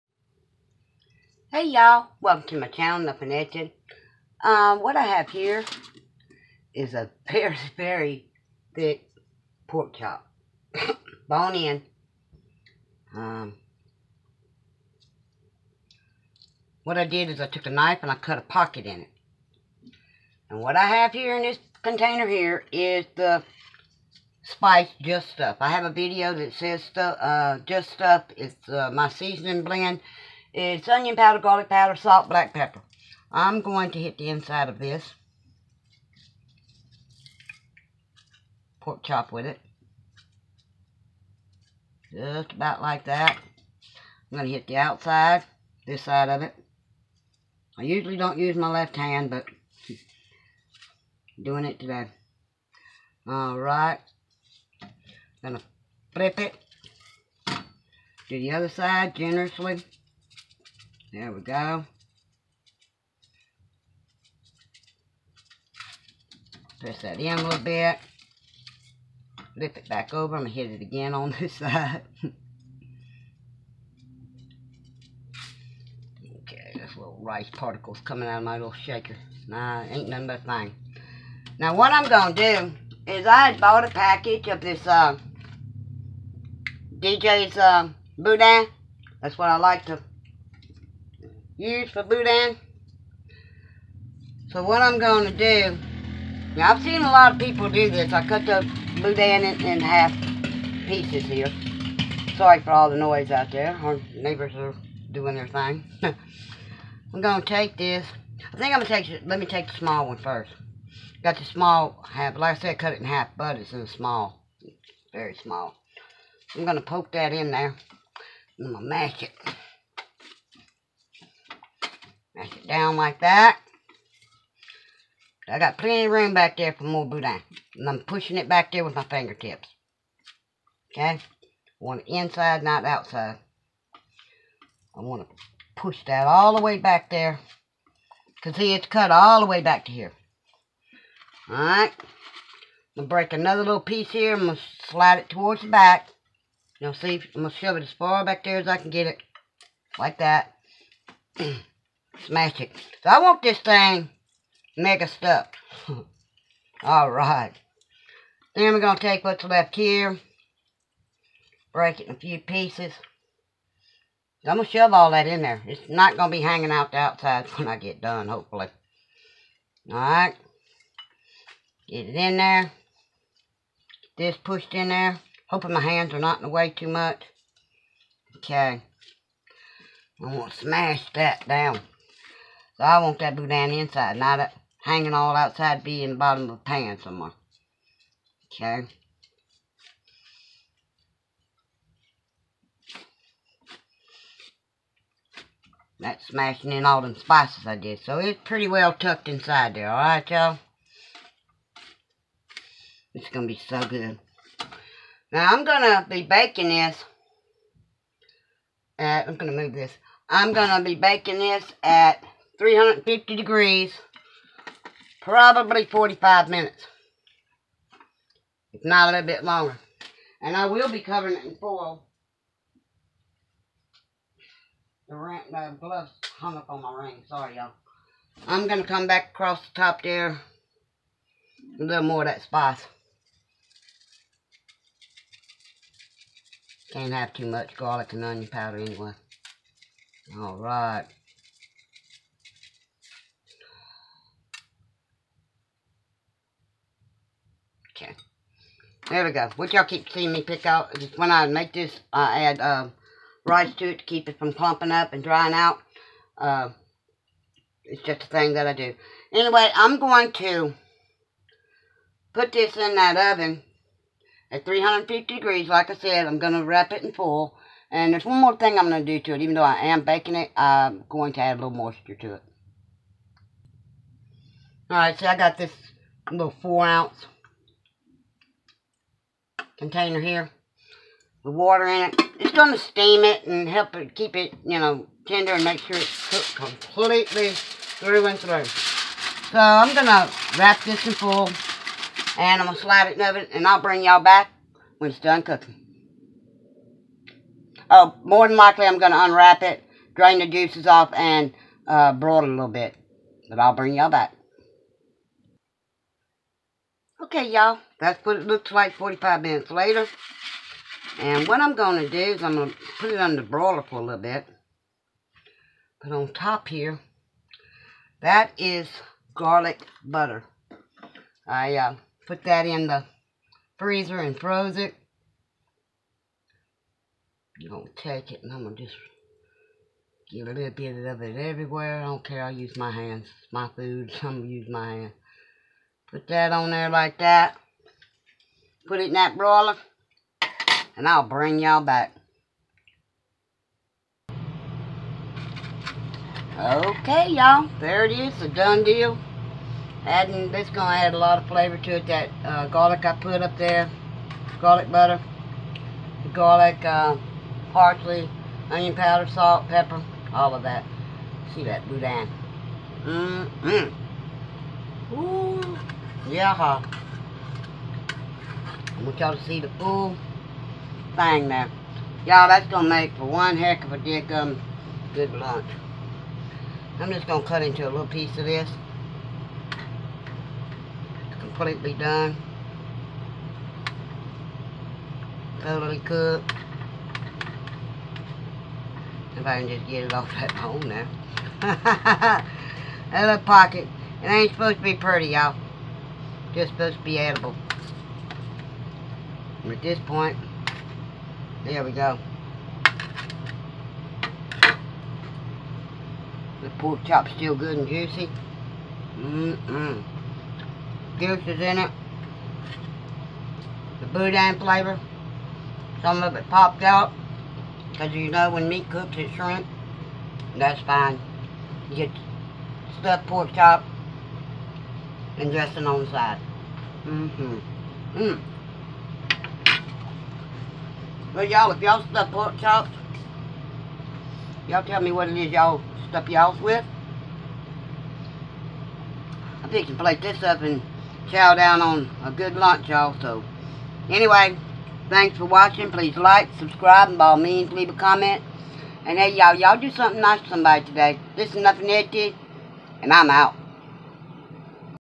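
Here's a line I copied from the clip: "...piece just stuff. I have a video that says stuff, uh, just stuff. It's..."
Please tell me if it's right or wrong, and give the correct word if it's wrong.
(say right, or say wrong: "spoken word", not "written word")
wrong: "spice", not "piece".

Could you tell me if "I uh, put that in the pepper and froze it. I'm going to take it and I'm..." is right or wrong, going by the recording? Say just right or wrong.
wrong.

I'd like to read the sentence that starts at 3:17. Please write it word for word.
So it's pretty well tucked inside there, alright y'all?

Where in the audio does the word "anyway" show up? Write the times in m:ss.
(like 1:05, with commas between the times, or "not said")
3:58, 4:19, 7:24.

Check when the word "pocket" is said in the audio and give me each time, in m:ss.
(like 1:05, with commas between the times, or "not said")
0:18, 6:33.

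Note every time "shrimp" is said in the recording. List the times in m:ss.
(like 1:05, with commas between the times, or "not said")
6:59.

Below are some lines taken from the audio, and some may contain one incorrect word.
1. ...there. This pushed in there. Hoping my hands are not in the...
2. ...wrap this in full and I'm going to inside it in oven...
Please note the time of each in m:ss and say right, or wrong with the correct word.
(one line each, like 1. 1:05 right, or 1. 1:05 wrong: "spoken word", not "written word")
1. 2:52 right
2. 4:50 wrong: "slide", not "inside".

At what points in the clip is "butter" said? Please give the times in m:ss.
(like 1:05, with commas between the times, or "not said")
5:20, 5:54.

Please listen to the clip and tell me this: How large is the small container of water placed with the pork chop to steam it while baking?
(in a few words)
4 ounce.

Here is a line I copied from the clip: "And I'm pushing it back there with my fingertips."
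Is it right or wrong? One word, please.
right.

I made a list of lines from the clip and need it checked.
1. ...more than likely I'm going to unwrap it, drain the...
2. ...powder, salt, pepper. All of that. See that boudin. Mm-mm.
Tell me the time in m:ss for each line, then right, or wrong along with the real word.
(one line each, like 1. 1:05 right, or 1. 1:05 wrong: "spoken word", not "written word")
1. 4:58 right
2. 5:58 right.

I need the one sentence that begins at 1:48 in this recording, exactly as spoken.
I think I'm going to take, let me take the small one first.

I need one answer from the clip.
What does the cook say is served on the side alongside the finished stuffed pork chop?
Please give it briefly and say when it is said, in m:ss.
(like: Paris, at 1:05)
dressing, at 7:05.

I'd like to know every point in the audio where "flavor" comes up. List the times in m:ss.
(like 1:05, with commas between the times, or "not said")
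5:51, 6:54.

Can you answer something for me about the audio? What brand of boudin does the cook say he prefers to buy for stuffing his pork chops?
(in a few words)
DJ's.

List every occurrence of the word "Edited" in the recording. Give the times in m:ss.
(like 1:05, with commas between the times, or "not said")
0:03, 7:31.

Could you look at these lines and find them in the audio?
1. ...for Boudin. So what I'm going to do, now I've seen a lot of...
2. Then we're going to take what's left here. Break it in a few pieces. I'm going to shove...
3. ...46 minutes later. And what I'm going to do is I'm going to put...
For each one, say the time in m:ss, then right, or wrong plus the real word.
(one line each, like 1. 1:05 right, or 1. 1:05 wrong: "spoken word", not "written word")
1. 1:31 right
2. 2:38 right
3. 5:08 wrong: "45", not "46".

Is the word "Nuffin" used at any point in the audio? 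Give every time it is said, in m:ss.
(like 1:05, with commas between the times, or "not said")
0:02, 7:31.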